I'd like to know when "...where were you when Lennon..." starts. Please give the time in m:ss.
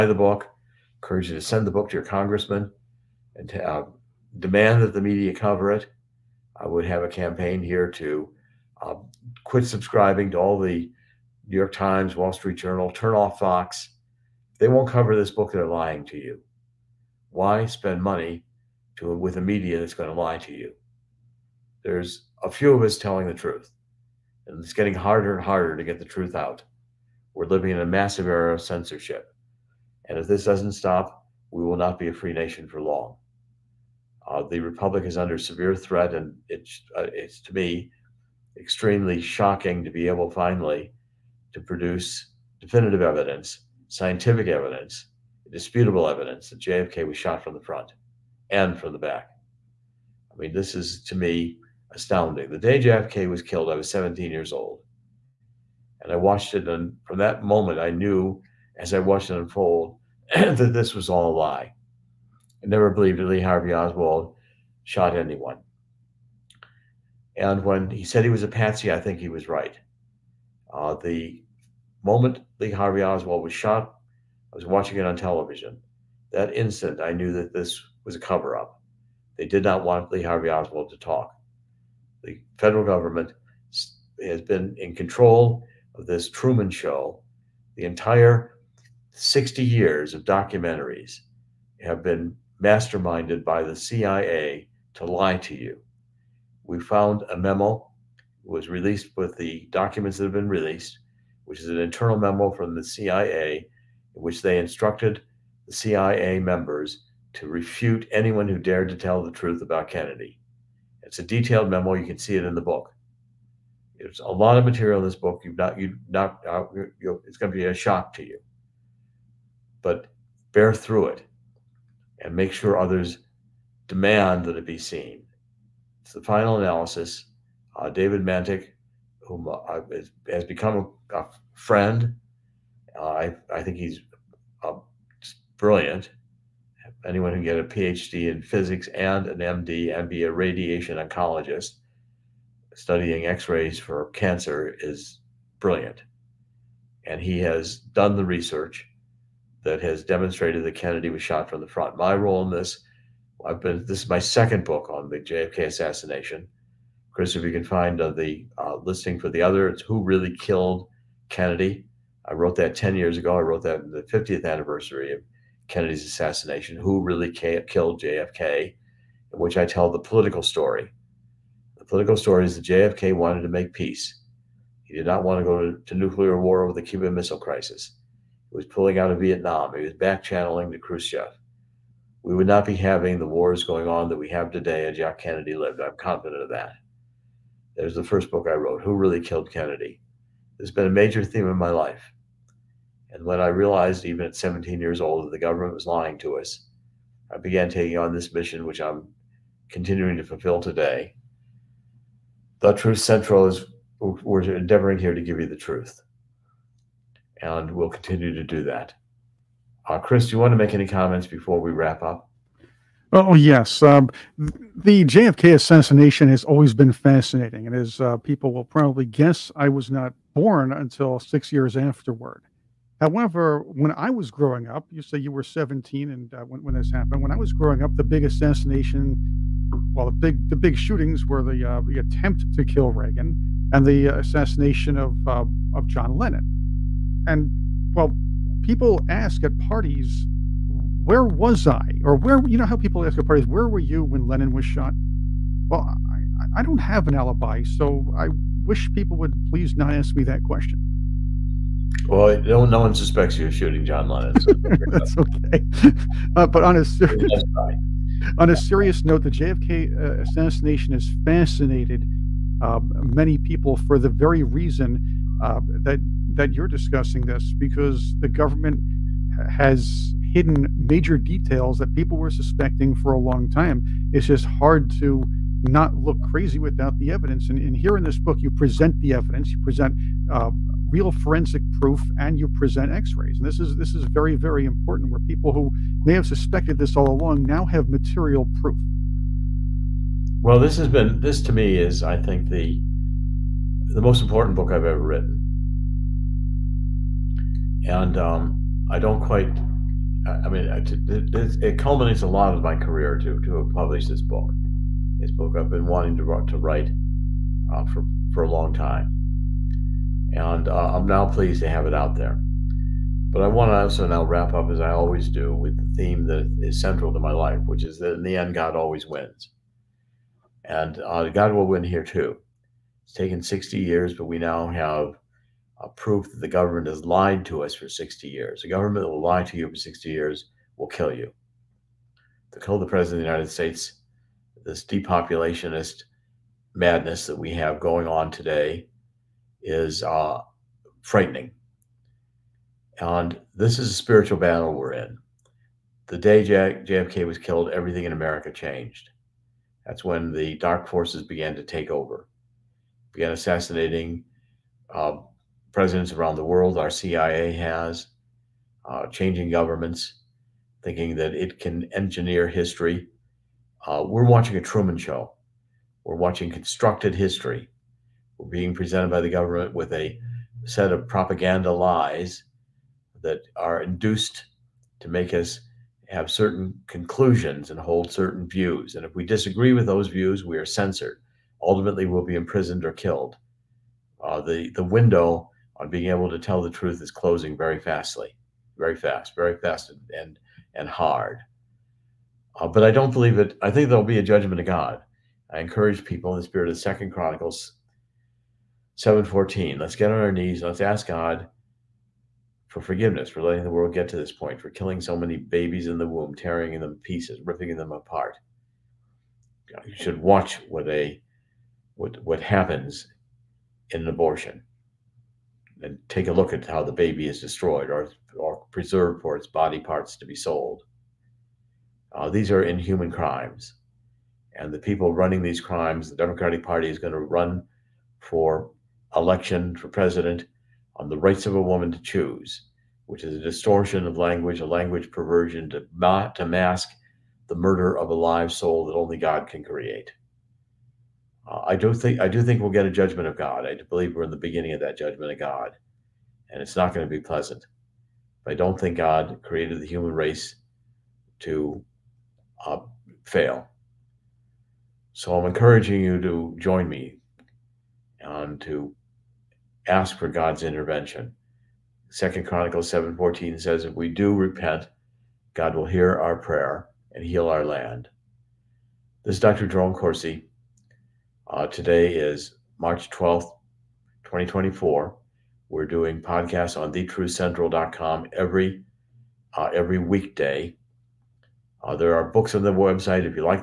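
4:03.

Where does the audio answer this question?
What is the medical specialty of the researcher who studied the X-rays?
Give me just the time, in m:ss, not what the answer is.
2:20.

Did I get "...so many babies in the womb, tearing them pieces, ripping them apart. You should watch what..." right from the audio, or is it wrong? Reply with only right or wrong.
right.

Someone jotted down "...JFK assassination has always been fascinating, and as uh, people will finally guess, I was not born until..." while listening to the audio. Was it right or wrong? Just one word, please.
wrong.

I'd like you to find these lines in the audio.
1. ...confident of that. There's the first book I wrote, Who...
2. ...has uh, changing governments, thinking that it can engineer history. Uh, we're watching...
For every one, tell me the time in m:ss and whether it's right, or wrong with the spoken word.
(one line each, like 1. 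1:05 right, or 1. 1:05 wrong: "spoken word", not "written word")
1. 3:05 right
2. 5:57 right.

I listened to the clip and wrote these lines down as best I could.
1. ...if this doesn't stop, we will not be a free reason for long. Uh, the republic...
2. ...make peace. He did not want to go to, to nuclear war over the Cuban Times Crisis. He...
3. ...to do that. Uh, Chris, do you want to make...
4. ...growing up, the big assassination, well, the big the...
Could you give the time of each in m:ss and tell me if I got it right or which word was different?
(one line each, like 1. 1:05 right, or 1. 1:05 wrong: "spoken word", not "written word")
1. 0:30 wrong: "nation", not "reason"
2. 2:53 wrong: "Missile", not "Times"
3. 3:28 right
4. 3:47 right.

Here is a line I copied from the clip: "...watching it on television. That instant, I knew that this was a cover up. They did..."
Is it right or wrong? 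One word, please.
right.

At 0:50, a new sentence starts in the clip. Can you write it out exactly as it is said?
I mean, this is to me astounding.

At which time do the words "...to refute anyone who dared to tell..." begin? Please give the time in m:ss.
1:47.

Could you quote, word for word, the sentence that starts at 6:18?
And if we disagree with those views, we are censored ultimately will be imprisoned or killed.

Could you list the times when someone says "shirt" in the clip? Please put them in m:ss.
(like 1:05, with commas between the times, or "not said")
not said.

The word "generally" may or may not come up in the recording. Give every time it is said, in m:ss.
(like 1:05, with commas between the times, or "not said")
not said.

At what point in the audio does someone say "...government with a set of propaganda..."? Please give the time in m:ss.
6:09.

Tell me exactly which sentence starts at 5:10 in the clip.
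And uh, I'm now pleased to have it out there.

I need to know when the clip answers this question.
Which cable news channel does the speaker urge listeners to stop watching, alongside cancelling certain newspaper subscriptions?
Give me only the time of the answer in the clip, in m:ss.
0:13.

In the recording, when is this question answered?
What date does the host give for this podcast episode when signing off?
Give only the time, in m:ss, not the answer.
7:52.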